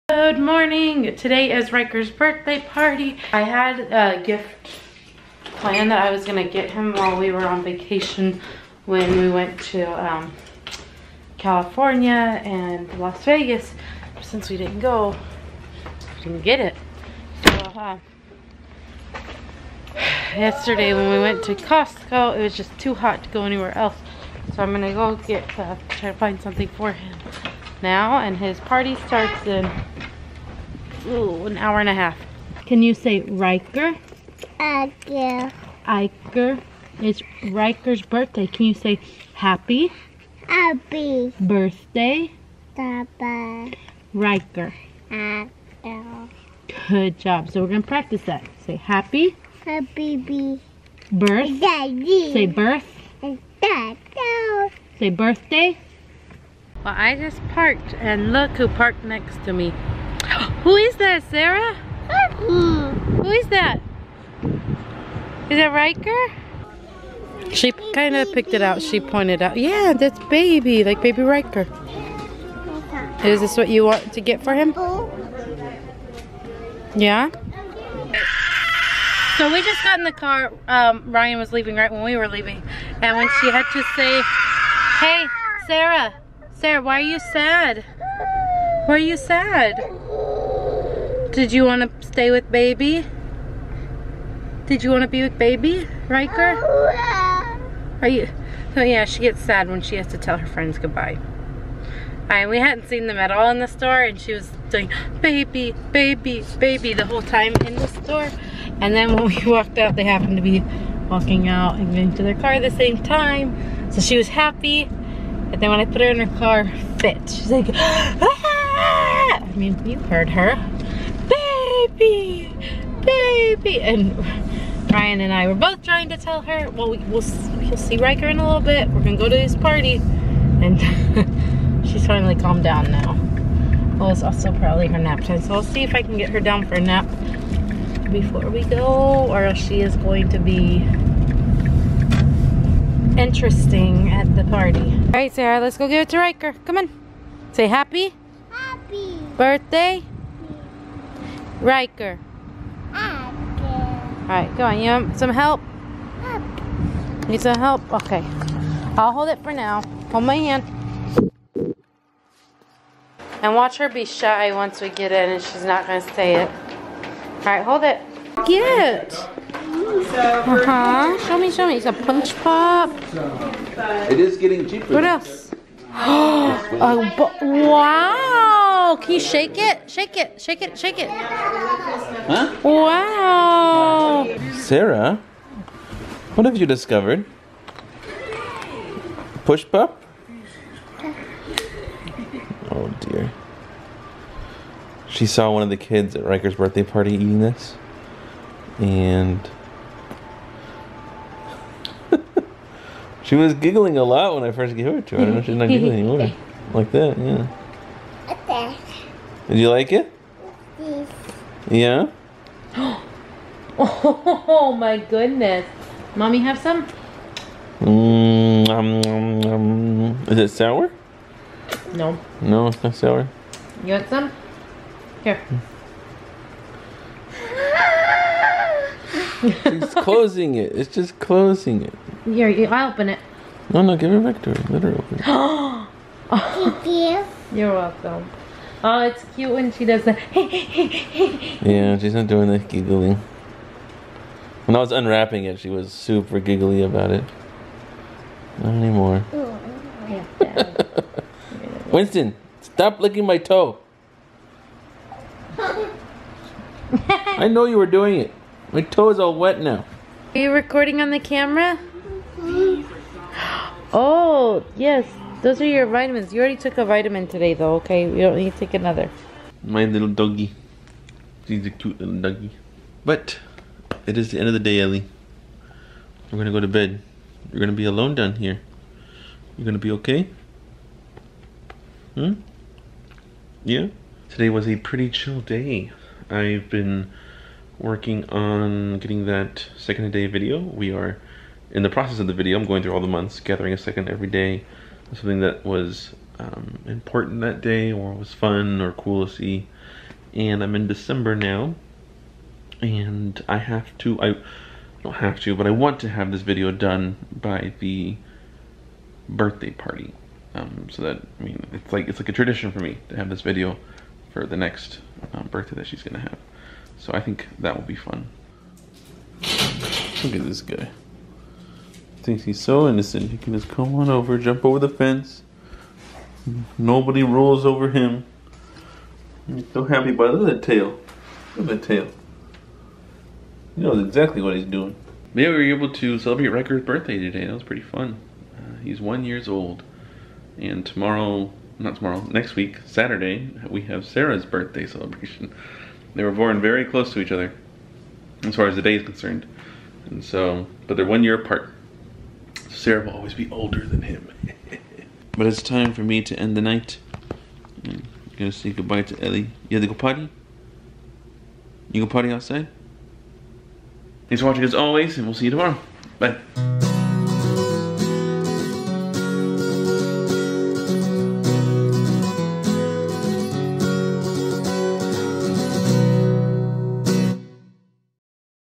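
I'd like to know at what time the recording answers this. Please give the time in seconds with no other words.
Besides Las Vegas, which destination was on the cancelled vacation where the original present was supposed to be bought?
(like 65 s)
11 s.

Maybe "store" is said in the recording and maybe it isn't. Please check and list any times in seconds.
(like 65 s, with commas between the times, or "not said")
103 s, 107 s.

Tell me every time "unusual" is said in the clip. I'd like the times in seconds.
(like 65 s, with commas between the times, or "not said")
not said.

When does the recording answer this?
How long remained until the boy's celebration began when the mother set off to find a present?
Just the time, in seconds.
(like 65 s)
31 s.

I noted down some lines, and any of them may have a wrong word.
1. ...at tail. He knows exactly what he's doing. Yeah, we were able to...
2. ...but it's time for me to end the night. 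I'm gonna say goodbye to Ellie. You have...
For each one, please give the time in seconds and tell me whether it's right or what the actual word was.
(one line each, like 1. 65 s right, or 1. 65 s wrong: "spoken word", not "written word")
1. 331 s right
2. 355 s right.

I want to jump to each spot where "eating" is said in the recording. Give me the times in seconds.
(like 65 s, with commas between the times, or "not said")
197 s.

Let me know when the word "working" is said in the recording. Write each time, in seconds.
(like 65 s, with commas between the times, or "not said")
287 s.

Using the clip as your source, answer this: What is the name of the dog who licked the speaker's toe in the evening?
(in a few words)
Winston.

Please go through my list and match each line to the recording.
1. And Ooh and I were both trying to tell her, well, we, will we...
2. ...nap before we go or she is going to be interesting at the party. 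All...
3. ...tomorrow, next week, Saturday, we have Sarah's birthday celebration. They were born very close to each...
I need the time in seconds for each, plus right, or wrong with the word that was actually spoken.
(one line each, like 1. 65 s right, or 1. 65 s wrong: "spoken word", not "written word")
1. 123 s wrong: "Ryan", not "Ooh"
2. 136 s right
3. 341 s right.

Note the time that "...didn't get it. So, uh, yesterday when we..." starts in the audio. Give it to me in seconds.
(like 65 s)
16 s.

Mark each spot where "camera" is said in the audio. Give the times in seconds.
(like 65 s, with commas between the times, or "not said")
261 s.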